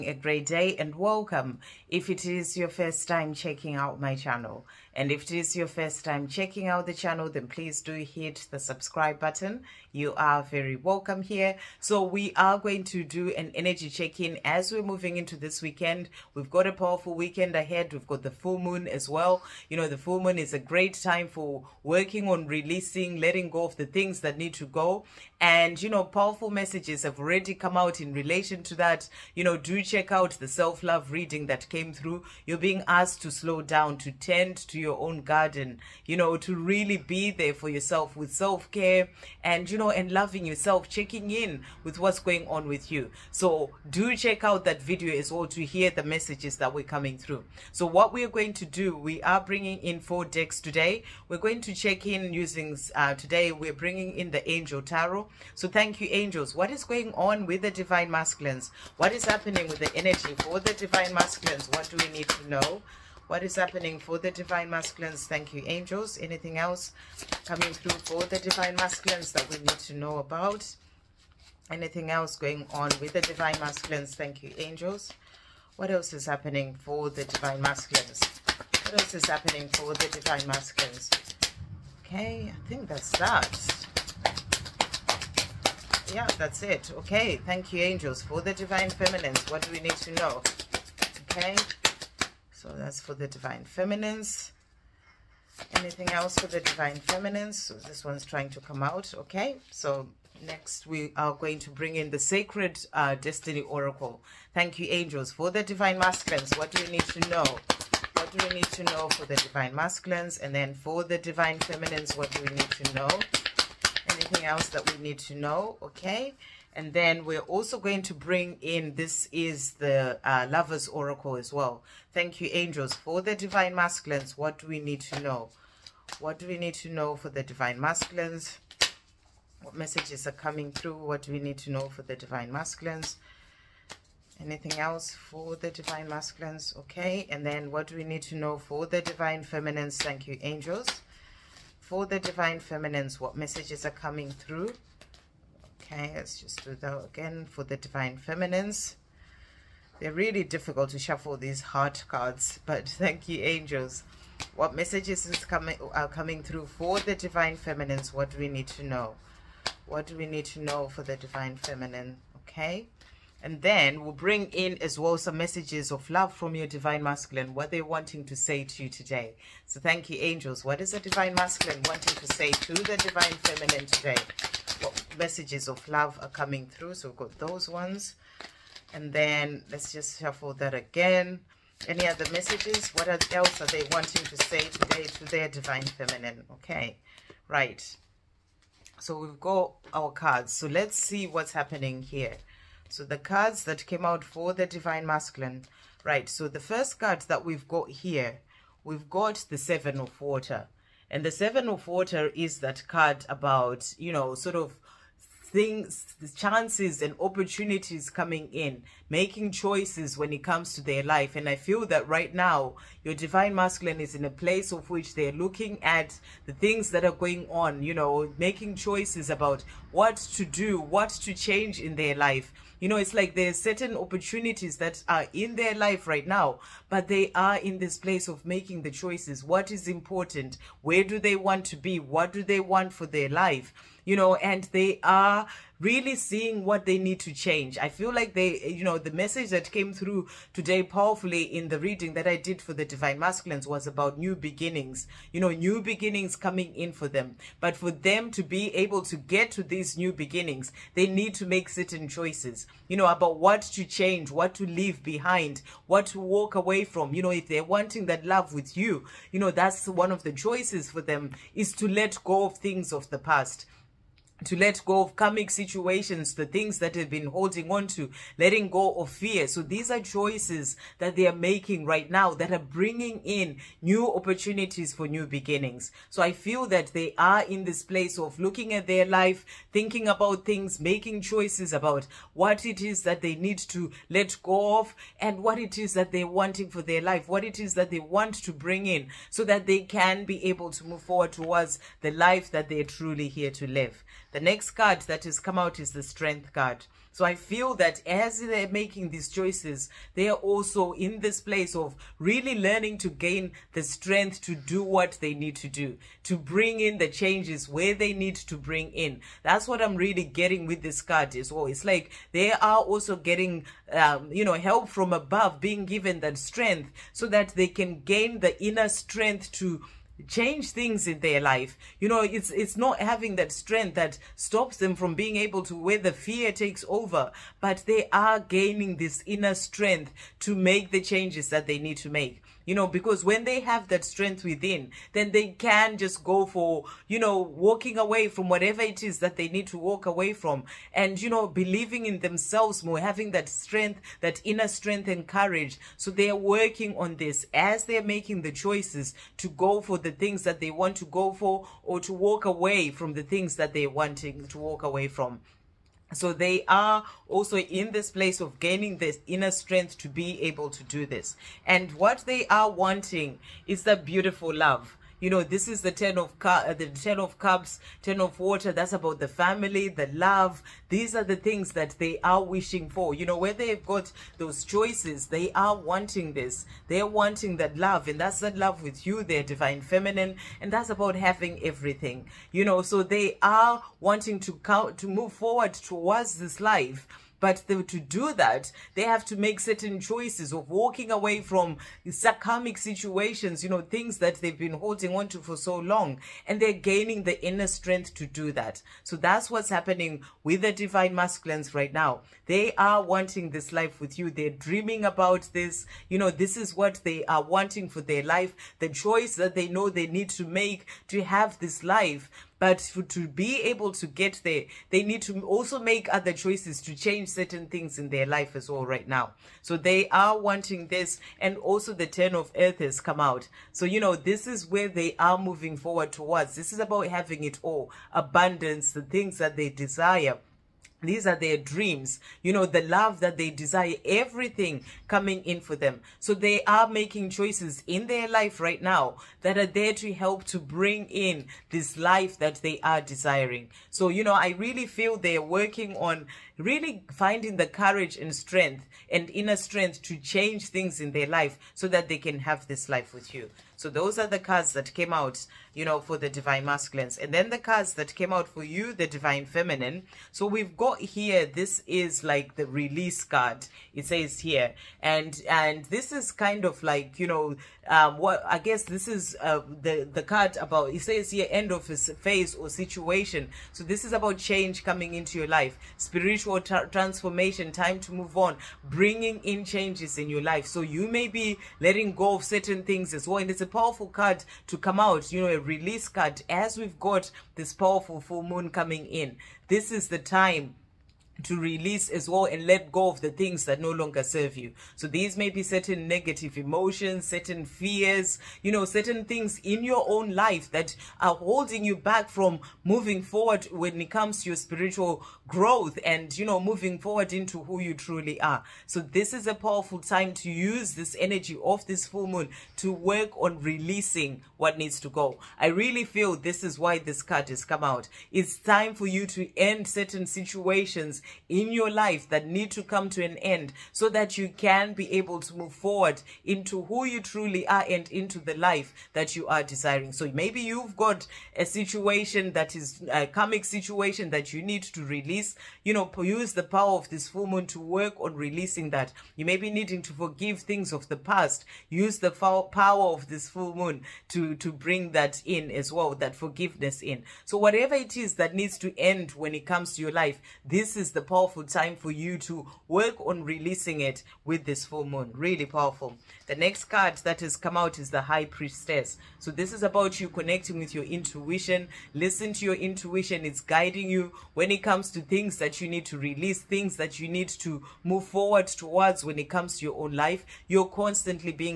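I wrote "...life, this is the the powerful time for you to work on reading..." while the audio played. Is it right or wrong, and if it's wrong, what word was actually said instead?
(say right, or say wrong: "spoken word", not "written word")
wrong: "releasing", not "reading".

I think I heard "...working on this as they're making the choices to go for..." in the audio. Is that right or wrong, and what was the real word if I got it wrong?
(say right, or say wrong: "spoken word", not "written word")
right.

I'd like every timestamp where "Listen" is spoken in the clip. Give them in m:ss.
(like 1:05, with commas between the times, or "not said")
9:22.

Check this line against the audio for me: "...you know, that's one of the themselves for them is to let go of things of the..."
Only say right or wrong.
wrong.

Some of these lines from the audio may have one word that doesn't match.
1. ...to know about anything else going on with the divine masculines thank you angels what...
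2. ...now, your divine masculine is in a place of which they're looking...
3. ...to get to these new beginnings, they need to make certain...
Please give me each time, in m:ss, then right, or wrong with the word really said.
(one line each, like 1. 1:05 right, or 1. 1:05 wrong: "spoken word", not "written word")
1. 1:09 right
2. 3:32 right
3. 4:09 right.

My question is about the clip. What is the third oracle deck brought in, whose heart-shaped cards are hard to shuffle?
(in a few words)
Lover's Oracle.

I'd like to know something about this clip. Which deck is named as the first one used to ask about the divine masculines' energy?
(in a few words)
Angel tarot.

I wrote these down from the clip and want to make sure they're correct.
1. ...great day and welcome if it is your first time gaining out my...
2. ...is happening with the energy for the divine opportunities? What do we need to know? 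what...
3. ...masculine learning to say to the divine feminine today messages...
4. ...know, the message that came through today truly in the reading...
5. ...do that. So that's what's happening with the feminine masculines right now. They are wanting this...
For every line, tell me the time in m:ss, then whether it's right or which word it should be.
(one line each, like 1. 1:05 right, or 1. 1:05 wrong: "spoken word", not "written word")
1. 0:00 wrong: "checking", not "gaining"
2. 0:59 wrong: "masculines", not "opportunities"
3. 2:51 wrong: "wanting", not "learning"
4. 3:58 wrong: "powerfully", not "truly"
5. 6:38 wrong: "divine", not "feminine".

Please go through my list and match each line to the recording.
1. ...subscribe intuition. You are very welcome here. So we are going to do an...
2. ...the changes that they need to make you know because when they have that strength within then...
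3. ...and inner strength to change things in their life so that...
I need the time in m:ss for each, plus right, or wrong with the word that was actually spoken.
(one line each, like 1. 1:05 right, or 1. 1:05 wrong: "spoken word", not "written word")
1. 0:08 wrong: "button", not "intuition"
2. 5:30 right
3. 7:29 right.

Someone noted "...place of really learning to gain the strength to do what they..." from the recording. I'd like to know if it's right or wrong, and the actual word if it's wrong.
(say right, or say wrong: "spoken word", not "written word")
right.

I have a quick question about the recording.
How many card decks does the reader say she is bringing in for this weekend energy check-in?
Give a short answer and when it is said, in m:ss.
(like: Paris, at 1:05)
4, at 0:49.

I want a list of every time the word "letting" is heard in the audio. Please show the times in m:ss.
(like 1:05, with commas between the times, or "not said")
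0:23, 4:28, 8:01.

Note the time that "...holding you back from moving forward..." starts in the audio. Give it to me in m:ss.
8:21.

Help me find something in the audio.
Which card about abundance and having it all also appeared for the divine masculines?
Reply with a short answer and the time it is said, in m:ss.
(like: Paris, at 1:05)
Ten of earth, at 7:02.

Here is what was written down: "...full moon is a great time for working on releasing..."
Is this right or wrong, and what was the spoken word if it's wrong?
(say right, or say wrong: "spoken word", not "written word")
right.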